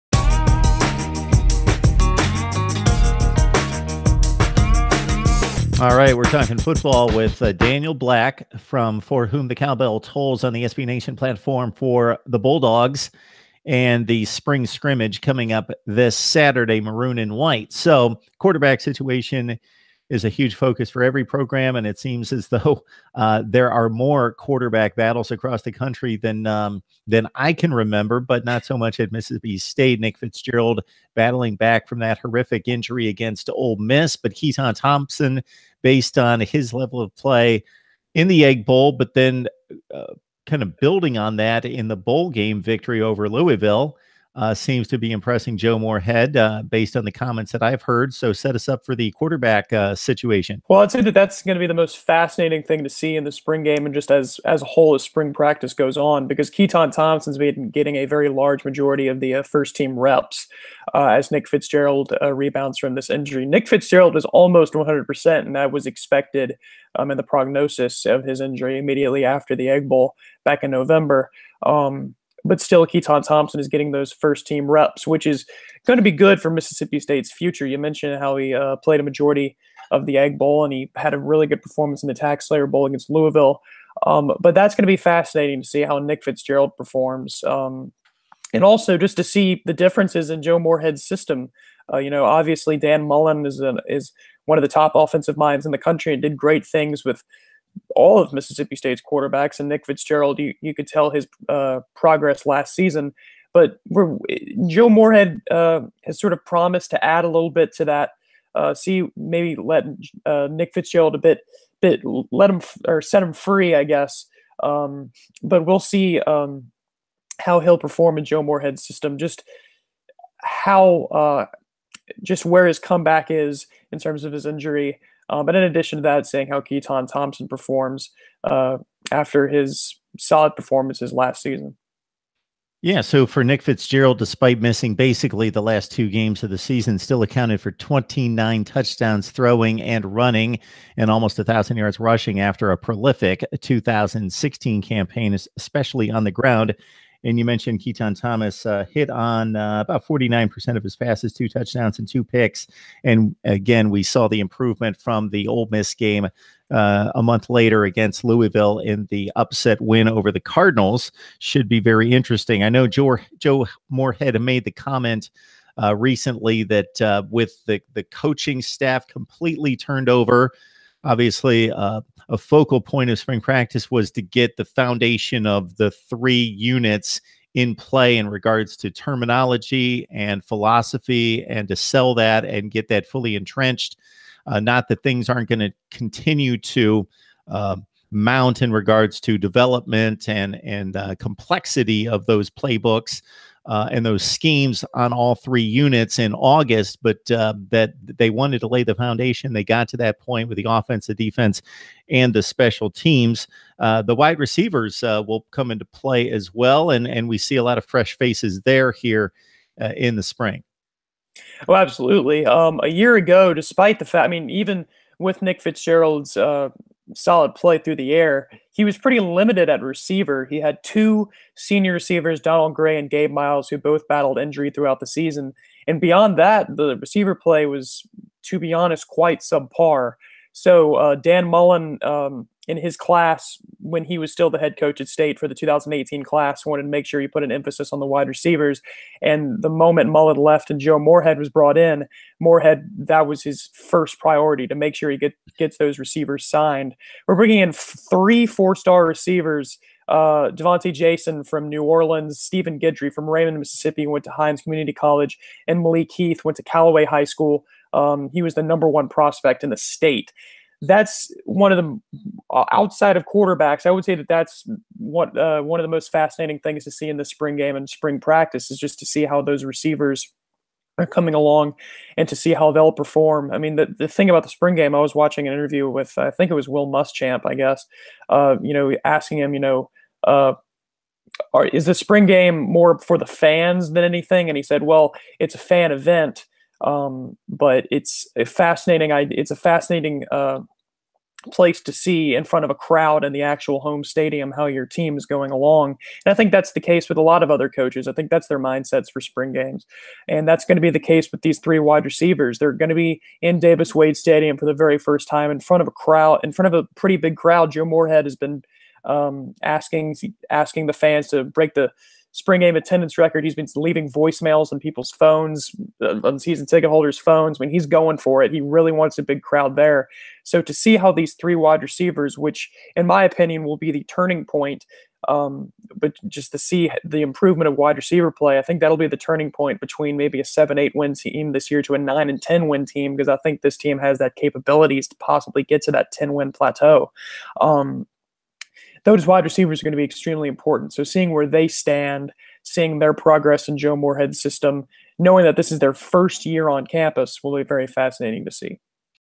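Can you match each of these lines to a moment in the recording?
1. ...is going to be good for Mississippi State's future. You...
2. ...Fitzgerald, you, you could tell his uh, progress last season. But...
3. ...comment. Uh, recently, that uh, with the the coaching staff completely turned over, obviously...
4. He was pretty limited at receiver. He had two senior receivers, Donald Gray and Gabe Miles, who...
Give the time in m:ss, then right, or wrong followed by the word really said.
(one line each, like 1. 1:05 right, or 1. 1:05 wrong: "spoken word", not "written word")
1. 1:15 right
2. 1:39 right
3. 2:44 right
4. 3:38 right.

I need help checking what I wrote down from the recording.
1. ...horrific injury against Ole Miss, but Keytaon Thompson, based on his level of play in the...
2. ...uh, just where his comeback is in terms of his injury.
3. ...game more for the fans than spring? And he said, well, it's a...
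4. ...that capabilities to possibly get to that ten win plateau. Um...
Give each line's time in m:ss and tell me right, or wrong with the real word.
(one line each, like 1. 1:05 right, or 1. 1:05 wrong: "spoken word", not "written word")
1. 0:32 right
2. 2:01 right
3. 4:42 wrong: "anything", not "spring"
4. 5:34 right.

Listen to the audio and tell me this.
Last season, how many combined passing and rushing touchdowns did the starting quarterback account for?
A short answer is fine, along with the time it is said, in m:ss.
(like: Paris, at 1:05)
29, at 2:17.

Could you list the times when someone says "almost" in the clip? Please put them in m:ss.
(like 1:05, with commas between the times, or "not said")
1:04, 2:21.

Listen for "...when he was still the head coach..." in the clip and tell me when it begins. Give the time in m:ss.
3:53.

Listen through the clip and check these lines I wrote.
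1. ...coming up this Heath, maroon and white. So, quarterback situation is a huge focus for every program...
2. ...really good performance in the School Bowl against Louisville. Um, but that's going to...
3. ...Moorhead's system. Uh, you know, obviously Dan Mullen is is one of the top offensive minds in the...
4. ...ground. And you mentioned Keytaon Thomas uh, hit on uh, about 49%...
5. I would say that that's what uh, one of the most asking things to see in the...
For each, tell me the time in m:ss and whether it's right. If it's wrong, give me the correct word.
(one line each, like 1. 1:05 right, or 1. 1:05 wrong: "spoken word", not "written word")
1. 0:15 wrong: "Saturday", not "Heath"
2. 1:21 wrong: "TaxSlayer", not "School"
3. 1:30 right
4. 2:26 right
5. 4:23 wrong: "fascinating", not "asking".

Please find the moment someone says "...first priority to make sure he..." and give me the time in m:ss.
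4:03.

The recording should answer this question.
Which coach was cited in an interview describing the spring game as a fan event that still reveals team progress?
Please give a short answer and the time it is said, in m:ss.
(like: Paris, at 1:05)
Will Muschamp, at 4:36.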